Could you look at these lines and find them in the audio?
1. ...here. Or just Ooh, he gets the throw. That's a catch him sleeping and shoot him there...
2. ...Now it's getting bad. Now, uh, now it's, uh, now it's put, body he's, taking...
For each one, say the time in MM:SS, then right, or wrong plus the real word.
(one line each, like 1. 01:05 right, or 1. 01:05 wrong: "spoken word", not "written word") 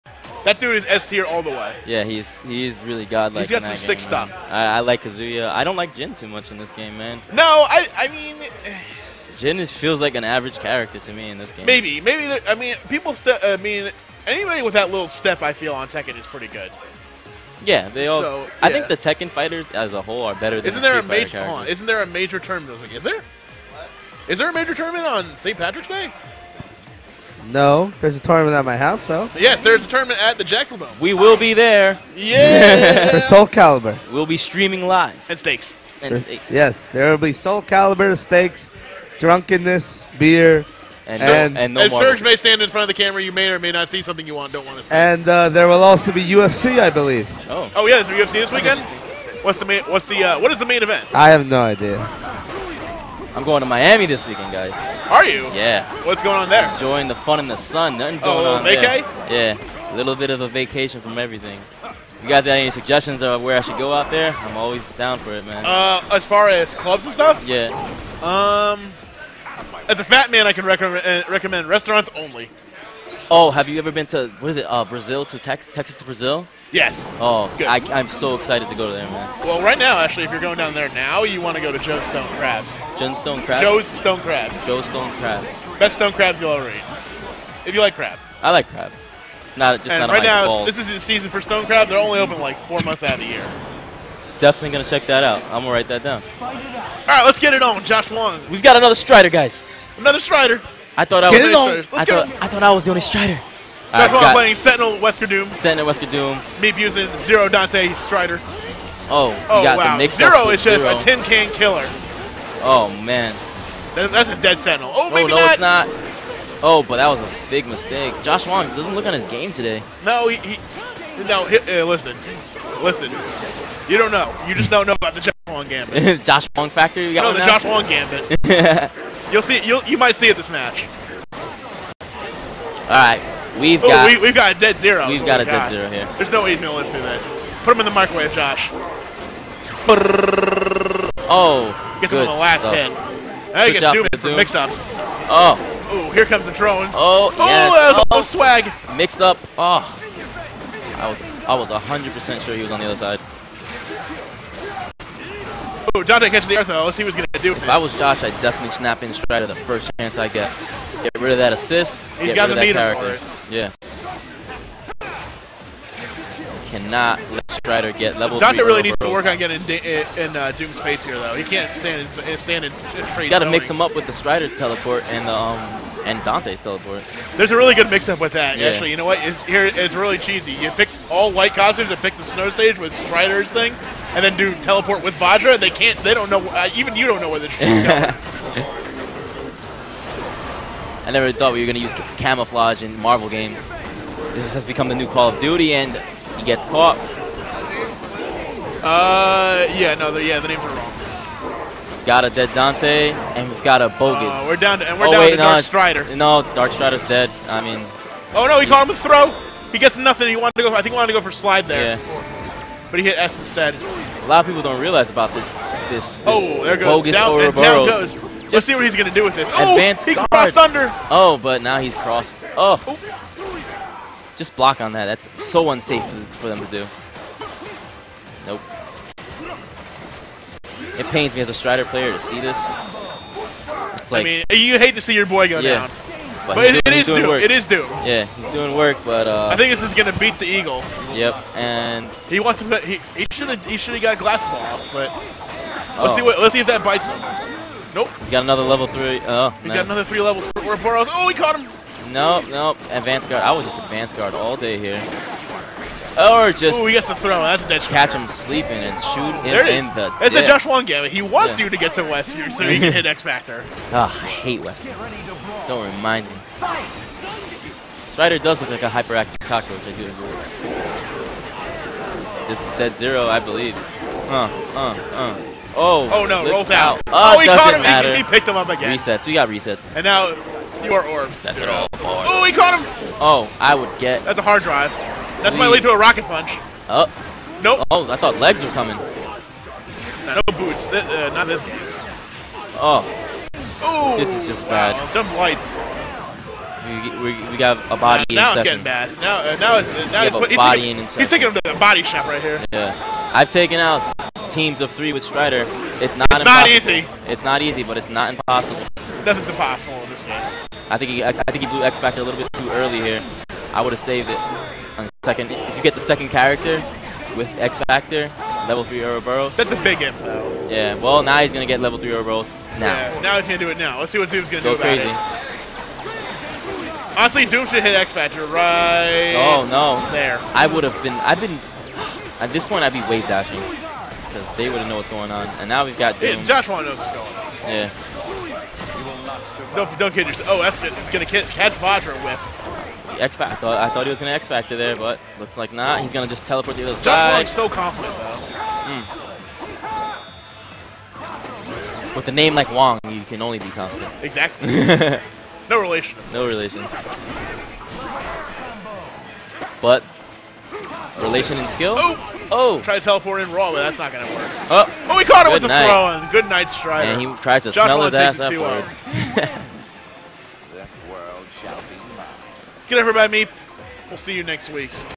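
1. 04:14 right
2. 04:58 right.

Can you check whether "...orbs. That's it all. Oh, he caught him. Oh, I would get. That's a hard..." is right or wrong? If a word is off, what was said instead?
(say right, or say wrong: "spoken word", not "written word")
right.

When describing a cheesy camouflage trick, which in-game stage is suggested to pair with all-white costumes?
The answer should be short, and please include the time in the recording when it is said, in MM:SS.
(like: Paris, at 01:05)
Snow stage, at 03:02.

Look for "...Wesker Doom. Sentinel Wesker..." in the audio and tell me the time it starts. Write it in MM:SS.
01:44.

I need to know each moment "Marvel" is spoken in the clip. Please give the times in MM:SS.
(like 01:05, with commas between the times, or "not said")
03:12.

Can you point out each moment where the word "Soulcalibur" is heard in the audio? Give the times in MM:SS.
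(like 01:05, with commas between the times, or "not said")
00:33, 00:37.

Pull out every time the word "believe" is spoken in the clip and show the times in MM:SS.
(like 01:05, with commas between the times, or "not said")
00:46, 04:33.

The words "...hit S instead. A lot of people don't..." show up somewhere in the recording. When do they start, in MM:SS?
03:33.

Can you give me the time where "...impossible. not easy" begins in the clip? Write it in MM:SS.
05:06.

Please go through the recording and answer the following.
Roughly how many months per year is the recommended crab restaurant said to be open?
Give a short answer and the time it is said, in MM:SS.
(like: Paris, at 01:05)
4, at 01:32.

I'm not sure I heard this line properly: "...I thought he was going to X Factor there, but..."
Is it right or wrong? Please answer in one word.
right.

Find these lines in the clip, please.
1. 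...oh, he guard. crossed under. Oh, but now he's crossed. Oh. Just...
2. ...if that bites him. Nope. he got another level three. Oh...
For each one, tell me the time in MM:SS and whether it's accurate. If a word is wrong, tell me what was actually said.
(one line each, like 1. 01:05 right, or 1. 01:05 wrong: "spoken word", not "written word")
1. 03:40 right
2. 04:06 right.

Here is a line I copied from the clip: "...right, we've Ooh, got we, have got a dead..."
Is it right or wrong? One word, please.
right.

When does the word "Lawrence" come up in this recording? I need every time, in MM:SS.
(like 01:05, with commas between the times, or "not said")
not said.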